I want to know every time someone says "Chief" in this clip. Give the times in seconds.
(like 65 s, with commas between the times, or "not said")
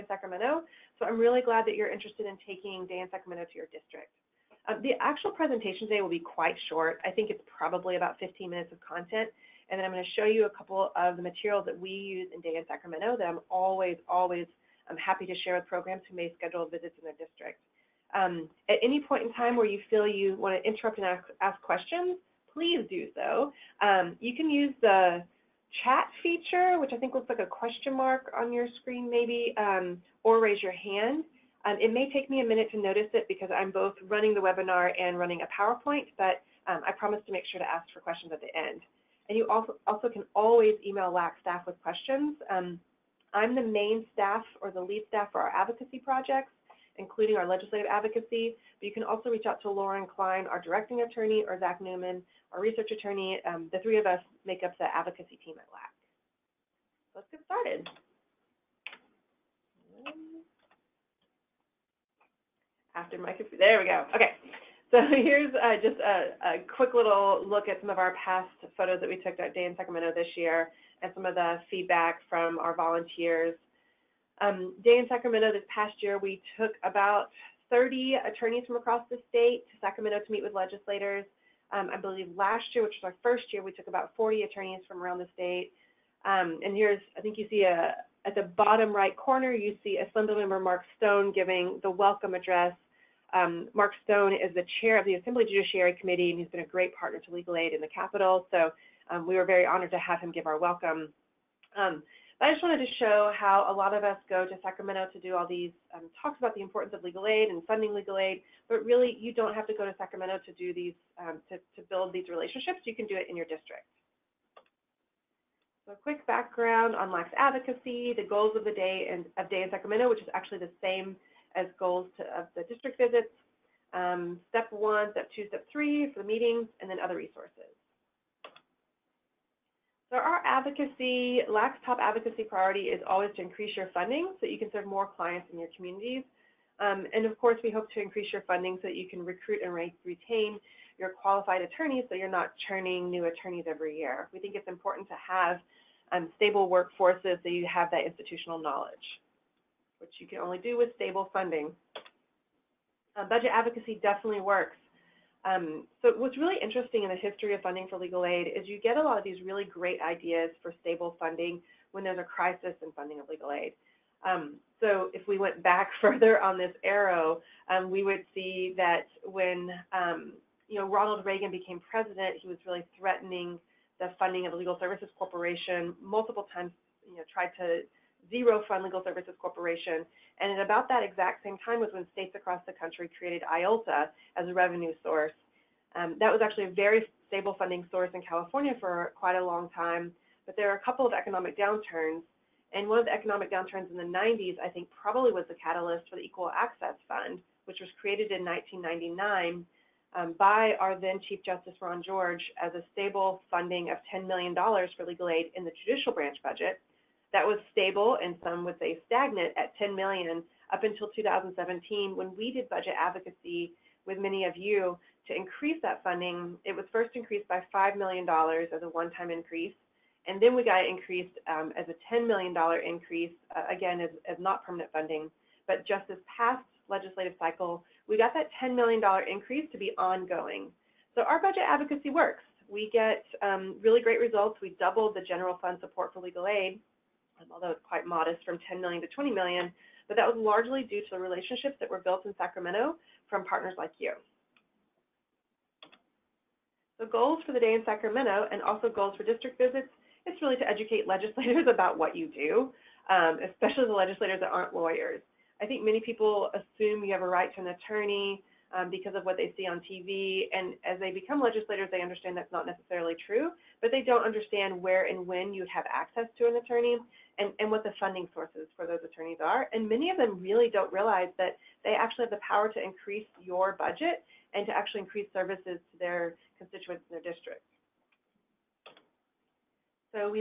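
201 s.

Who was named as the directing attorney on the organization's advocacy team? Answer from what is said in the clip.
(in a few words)
Lauren Klein.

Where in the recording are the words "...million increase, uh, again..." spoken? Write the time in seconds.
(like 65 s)
222 s.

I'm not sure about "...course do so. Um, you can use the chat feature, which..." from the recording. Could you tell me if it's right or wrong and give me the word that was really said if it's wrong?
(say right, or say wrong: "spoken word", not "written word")
wrong: "please", not "course".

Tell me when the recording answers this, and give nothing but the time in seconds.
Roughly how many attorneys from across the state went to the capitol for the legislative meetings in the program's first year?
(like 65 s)
83 s.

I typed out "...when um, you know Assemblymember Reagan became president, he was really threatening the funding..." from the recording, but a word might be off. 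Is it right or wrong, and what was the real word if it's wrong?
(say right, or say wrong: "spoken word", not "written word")
wrong: "Ronald", not "Assemblymember".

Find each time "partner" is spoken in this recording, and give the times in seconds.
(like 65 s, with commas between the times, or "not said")
96 s, 243 s.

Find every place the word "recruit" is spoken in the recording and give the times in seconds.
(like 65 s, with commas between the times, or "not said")
139 s.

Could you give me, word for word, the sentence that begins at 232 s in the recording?
We get um, really great results.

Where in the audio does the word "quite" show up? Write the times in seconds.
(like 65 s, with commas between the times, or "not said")
6 s, 189 s, 237 s.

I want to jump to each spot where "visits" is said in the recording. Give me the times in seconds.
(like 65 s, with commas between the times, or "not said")
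16 s, 122 s, 249 s.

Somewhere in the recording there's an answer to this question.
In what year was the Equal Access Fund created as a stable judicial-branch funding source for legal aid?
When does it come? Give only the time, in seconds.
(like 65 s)
198 s.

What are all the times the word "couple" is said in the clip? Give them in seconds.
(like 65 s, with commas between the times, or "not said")
10 s, 190 s.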